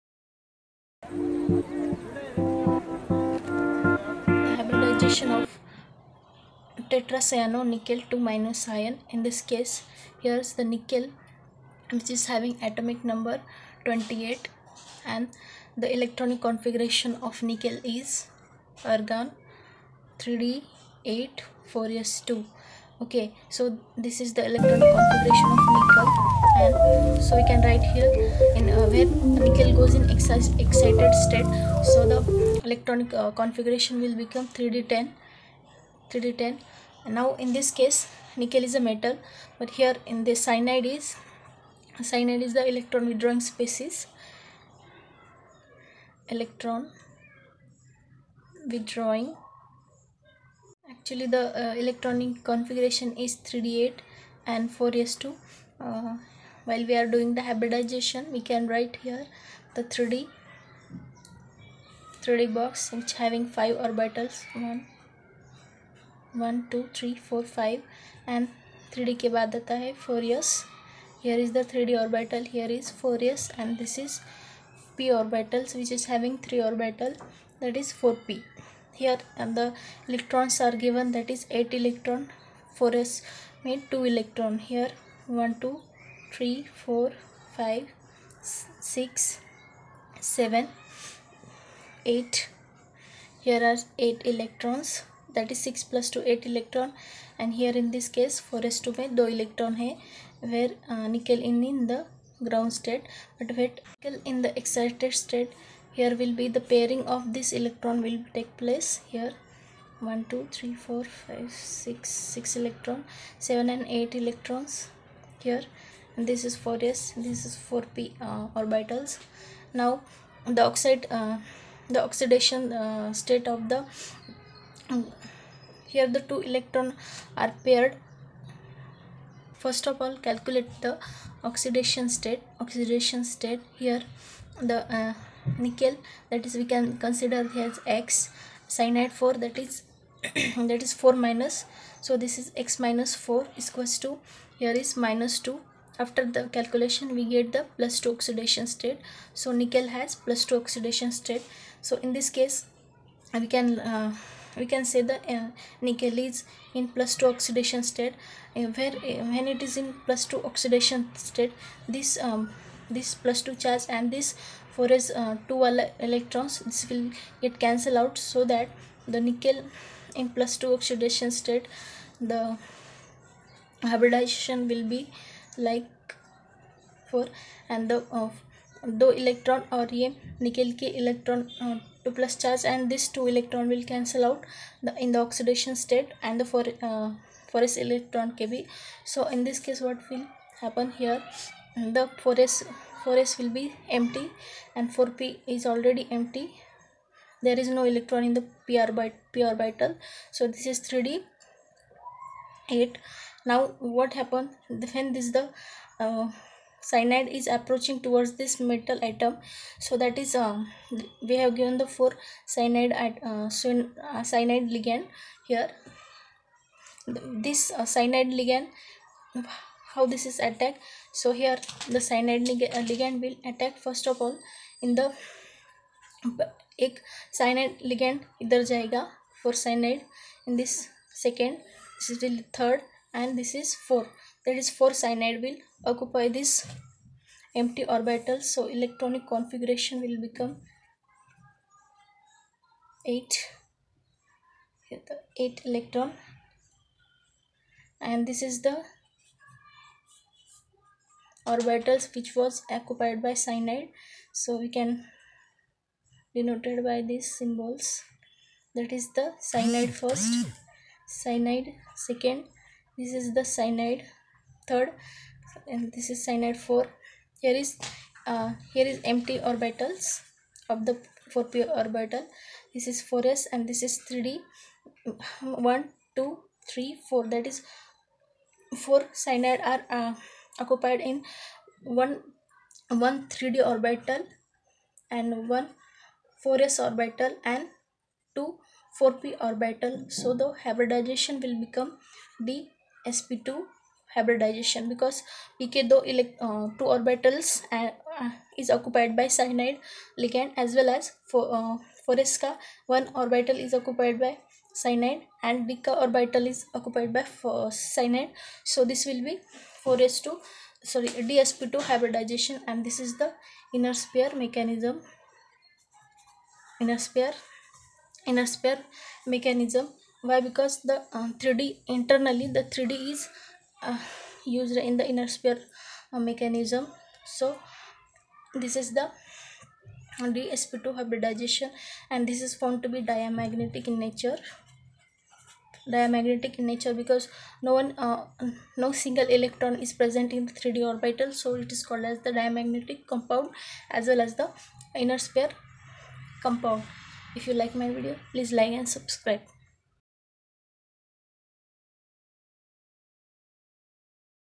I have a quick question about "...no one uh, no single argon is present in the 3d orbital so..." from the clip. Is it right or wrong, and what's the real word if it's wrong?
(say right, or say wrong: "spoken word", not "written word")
wrong: "electron", not "argon".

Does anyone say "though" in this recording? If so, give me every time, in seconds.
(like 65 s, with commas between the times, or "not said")
295 s.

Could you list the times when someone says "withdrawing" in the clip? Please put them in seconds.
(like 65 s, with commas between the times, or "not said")
43 s, 48 s.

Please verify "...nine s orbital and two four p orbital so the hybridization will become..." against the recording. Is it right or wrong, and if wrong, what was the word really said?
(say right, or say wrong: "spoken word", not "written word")
wrong: "four", not "nine".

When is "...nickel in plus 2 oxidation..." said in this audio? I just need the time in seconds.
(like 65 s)
169 s.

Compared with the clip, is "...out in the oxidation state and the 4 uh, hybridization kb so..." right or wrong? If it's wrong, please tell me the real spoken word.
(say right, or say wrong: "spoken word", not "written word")
wrong: "electron", not "hybridization".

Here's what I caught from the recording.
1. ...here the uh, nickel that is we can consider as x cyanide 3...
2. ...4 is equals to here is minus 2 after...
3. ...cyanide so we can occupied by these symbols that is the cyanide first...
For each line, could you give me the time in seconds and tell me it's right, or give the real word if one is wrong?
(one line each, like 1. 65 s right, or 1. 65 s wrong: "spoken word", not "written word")
1. 133 s wrong: "4", not "3"
2. 143 s right
3. 253 s wrong: "denoted", not "occupied".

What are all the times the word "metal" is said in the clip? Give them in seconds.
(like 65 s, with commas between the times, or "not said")
38 s, 208 s.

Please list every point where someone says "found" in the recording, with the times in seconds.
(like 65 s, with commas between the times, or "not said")
332 s.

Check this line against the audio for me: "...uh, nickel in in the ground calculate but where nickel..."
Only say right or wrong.
wrong.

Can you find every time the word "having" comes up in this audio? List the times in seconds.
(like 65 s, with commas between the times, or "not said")
12 s, 63 s, 76 s.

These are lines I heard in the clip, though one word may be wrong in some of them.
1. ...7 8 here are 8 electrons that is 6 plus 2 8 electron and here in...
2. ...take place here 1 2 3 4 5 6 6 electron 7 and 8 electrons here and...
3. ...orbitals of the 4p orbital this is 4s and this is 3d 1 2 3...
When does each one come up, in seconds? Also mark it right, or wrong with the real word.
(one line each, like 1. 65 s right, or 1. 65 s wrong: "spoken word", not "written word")
1. 90 s right
2. 108 s right
3. 269 s right.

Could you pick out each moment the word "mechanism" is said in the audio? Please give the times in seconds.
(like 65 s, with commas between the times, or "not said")
314 s, 319 s, 326 s.